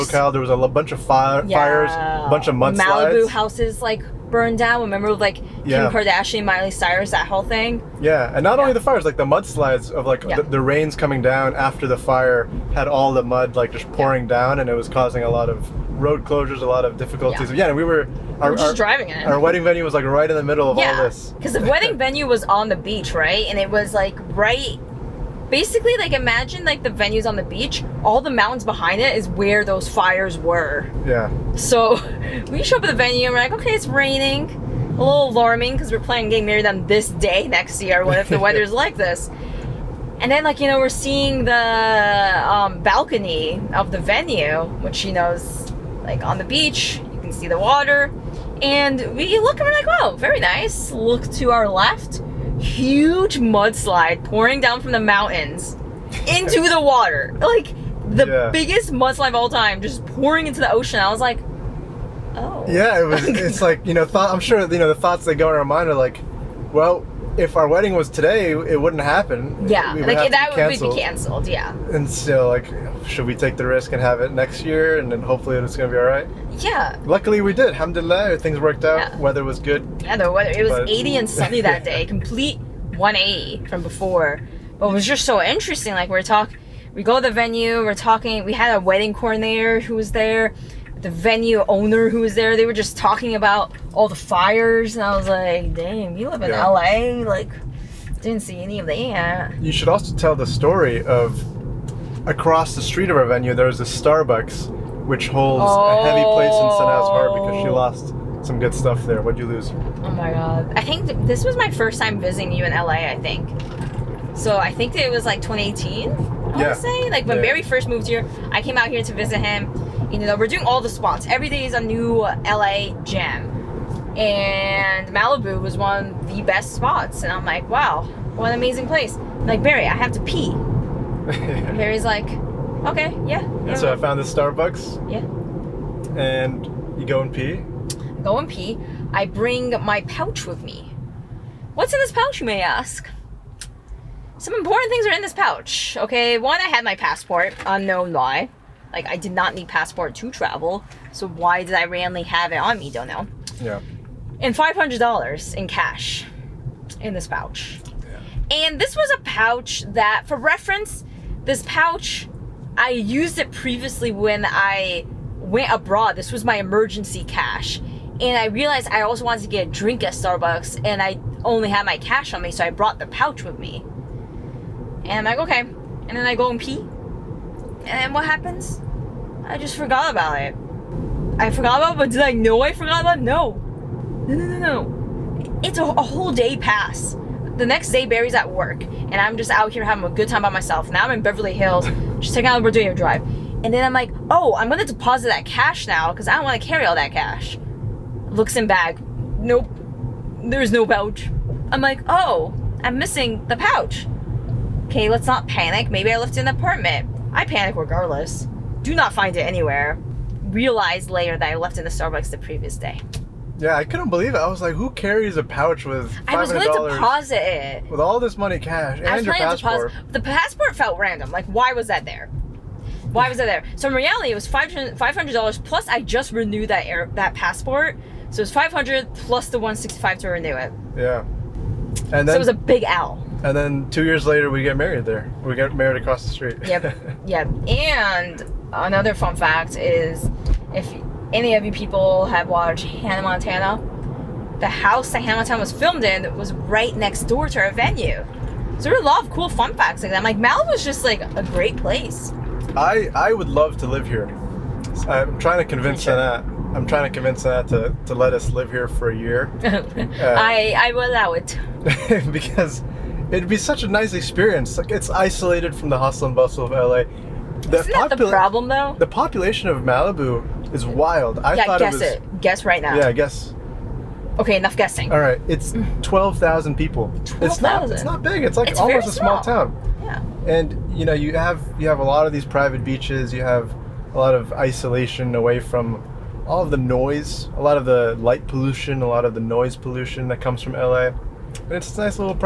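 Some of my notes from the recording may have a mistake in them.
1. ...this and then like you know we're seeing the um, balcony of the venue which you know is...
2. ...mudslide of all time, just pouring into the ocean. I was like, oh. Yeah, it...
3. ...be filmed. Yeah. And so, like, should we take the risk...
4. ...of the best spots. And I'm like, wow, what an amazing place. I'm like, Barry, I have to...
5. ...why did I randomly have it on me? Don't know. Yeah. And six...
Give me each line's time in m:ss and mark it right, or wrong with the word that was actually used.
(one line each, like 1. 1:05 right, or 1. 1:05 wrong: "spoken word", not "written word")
1. 0:38 right
2. 0:58 right
3. 1:10 wrong: "canceled", not "filmed"
4. 2:06 right
5. 2:31 wrong: "five", not "six".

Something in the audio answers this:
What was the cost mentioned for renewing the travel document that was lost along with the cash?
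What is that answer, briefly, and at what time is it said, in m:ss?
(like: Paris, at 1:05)
165, at 3:49.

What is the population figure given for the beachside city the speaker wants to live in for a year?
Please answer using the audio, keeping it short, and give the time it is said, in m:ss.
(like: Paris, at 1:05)
12,000, at 4:36.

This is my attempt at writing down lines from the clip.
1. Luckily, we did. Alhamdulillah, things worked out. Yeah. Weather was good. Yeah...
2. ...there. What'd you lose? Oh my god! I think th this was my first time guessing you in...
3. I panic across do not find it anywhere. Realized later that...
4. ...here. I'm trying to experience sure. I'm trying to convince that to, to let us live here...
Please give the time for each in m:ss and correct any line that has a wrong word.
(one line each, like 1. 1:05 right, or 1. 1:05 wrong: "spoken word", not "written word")
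1. 1:17 right
2. 1:49 wrong: "visiting", not "guessing"
3. 3:27 wrong: "regardless", not "across"
4. 4:14 wrong: "convince", not "experience".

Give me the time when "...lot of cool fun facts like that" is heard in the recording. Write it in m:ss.
4:09.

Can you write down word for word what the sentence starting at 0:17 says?
Yeah, yeah and we were our, we are just driving it.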